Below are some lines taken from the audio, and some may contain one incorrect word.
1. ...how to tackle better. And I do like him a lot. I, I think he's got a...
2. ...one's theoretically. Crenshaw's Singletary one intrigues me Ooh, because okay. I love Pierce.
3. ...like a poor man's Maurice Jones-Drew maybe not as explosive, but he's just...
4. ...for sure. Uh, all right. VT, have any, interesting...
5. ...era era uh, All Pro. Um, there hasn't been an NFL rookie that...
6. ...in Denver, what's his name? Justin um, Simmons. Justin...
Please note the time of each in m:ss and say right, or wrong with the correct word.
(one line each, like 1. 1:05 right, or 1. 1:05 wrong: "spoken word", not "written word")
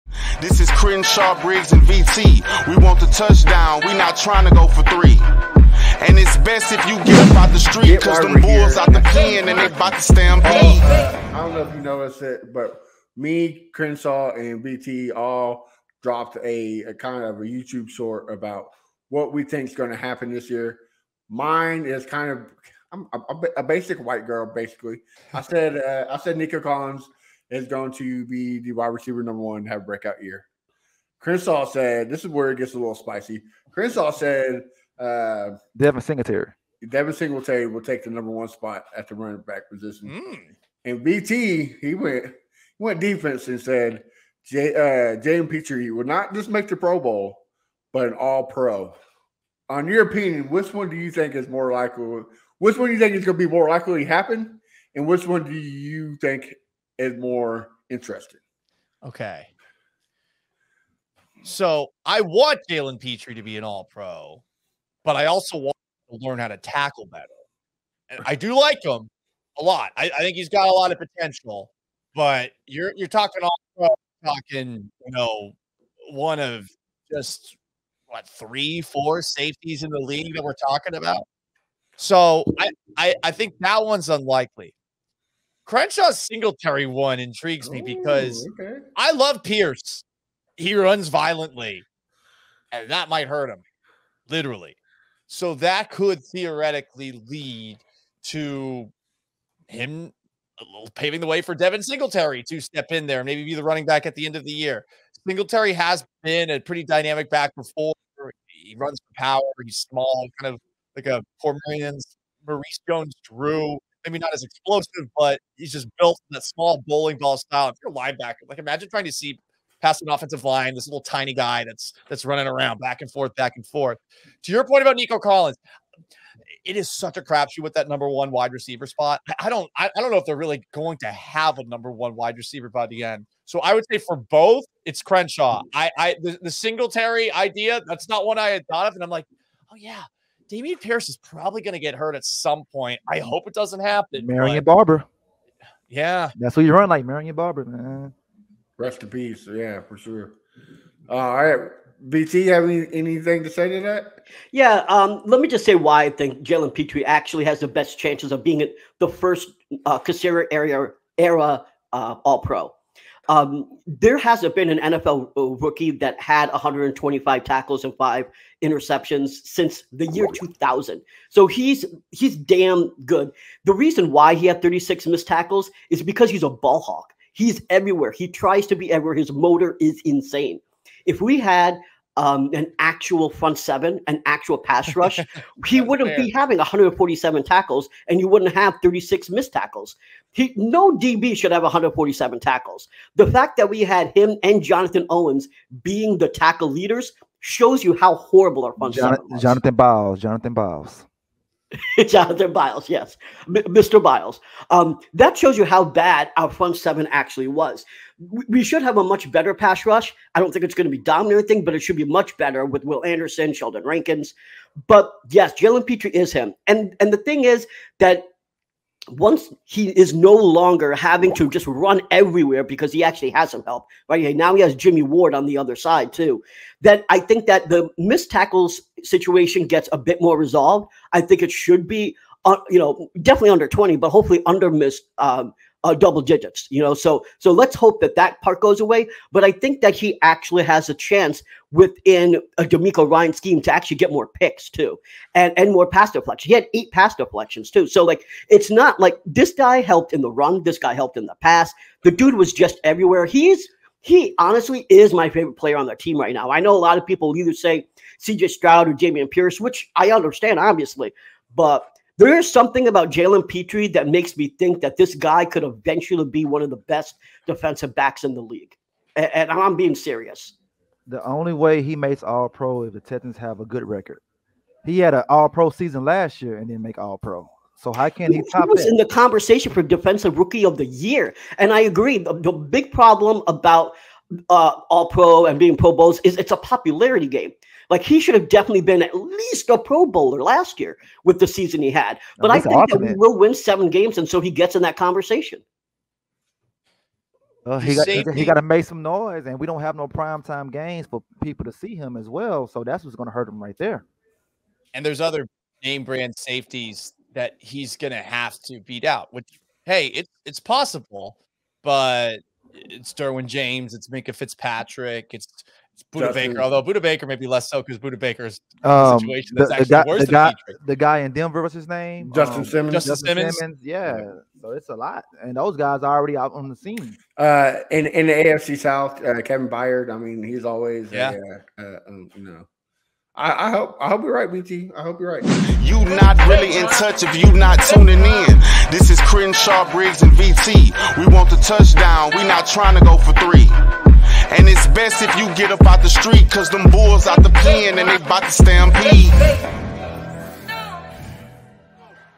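1. 1:06 right
2. 1:23 wrong: "unlikely", not "theoretically"
3. 1:50 right
4. 2:29 wrong: "anything", not "interesting"
5. 2:40 right
6. 5:21 right.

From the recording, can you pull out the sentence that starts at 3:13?
The fact that we had him and Jonathan Owens being the tackle leaders shows you how horrible our front seven was.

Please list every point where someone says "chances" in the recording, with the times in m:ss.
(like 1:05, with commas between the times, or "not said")
2:37, 4:00.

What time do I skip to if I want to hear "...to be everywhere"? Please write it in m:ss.
2:58.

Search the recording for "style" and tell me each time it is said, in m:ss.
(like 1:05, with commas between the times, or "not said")
1:57.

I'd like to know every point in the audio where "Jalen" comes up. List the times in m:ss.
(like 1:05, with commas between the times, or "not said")
1:02, 2:36, 3:35, 4:23.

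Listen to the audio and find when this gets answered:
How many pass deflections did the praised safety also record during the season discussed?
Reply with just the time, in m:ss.
4:06.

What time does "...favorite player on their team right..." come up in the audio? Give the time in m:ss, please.
4:15.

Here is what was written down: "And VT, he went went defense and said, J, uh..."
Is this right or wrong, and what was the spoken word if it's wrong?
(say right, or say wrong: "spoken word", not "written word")
right.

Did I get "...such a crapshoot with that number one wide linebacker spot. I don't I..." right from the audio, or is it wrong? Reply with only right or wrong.
wrong.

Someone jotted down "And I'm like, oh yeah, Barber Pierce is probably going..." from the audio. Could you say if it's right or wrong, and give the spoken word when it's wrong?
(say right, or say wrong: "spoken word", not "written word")
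wrong: "Dameon", not "Barber".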